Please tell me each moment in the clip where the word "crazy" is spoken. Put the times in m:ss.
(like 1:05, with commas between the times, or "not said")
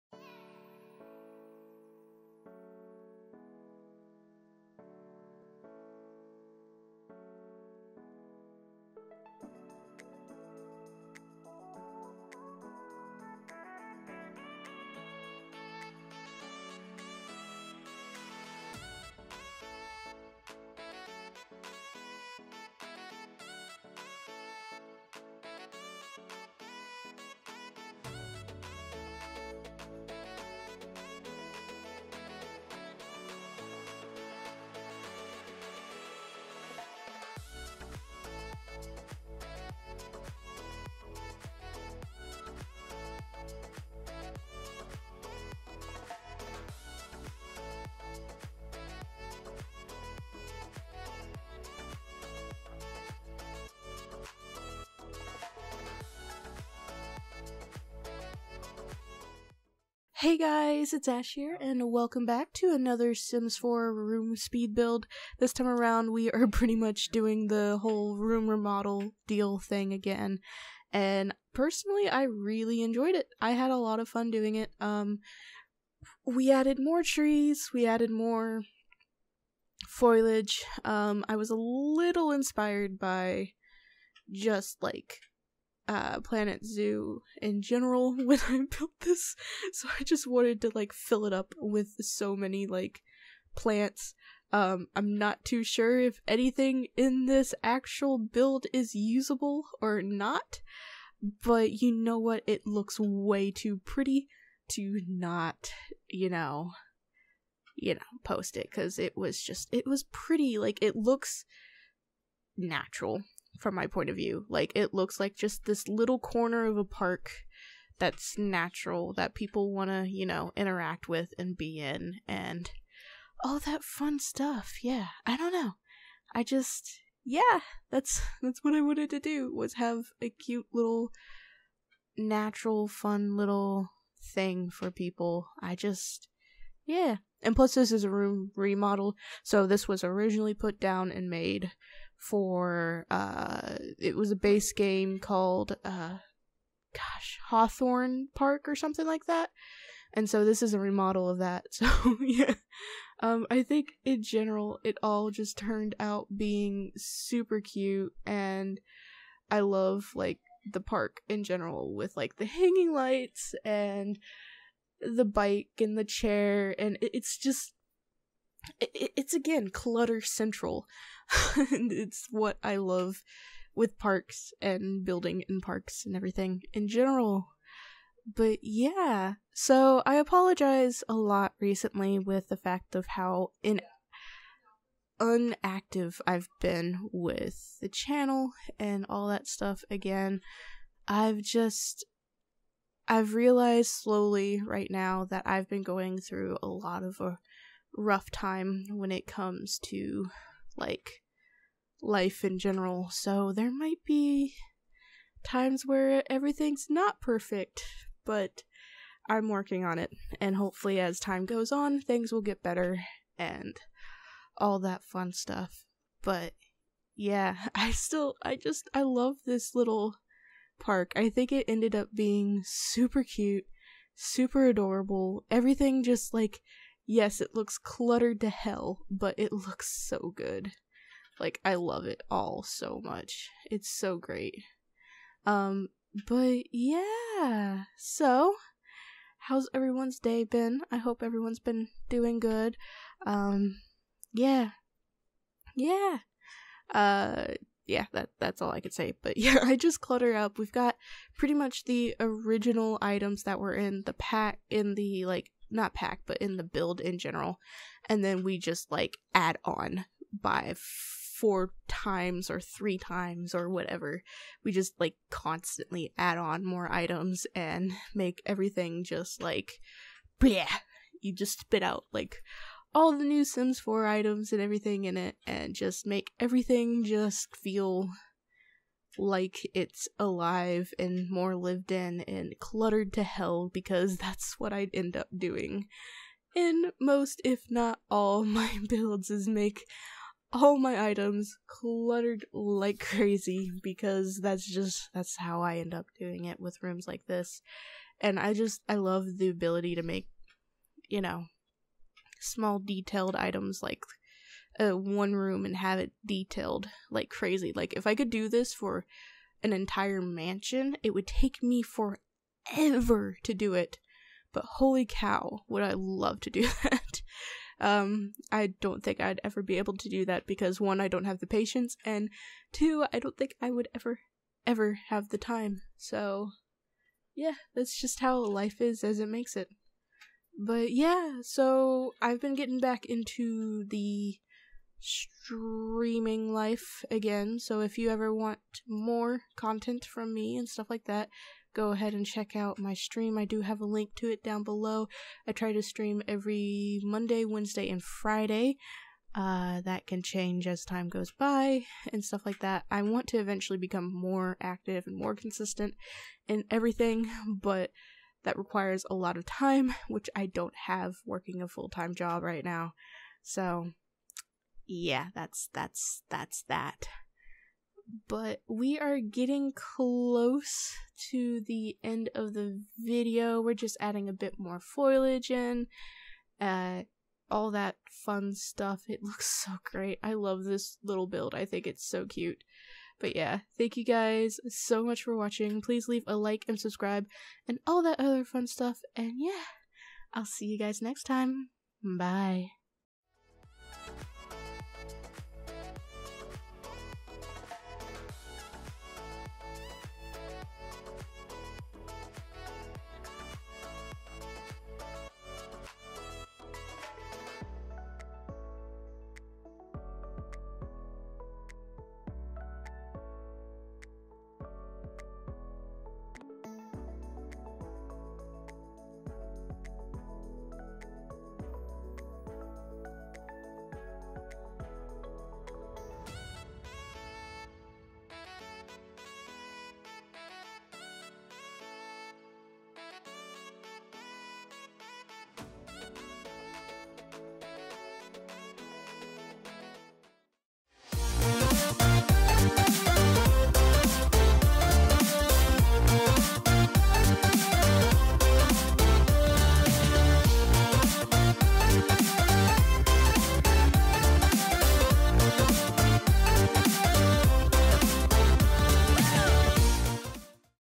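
4:52, 5:07.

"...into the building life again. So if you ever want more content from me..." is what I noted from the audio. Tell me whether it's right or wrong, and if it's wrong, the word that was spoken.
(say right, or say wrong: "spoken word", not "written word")
wrong: "streaming", not "building".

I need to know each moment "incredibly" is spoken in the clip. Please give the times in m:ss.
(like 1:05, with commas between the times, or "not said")
not said.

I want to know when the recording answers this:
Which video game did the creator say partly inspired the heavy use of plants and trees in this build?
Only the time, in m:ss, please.
1:26.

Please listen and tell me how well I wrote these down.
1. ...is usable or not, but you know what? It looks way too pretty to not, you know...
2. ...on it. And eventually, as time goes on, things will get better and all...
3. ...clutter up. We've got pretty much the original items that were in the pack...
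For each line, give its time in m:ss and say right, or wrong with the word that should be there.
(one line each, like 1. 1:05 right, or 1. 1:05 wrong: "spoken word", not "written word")
1. 1:38 right
2. 3:29 wrong: "hopefully", not "eventually"
3. 4:10 right.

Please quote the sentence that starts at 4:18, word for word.
And then we just like add on by four times or three times or whatever.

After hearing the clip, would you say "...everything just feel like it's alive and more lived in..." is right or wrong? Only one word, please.
right.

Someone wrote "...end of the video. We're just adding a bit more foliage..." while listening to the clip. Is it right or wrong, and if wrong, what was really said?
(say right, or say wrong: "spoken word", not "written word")
right.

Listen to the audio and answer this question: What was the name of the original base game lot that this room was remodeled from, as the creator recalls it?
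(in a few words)
Hawthorn Park.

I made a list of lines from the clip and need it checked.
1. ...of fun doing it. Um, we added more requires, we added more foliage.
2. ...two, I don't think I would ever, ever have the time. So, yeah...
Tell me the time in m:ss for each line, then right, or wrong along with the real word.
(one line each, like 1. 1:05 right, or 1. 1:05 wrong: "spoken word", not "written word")
1. 1:13 wrong: "trees", not "requires"
2. 5:22 right.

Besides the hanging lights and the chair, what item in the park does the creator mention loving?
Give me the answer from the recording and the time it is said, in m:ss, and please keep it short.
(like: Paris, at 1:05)
The bike, at 2:45.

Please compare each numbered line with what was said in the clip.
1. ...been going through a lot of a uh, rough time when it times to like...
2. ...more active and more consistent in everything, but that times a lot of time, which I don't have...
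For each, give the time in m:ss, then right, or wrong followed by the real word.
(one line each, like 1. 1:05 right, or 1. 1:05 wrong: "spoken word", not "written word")
1. 3:15 wrong: "comes", not "times"
2. 5:54 wrong: "requires", not "times".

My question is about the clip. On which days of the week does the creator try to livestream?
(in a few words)
Monday, Wednesday, and Friday.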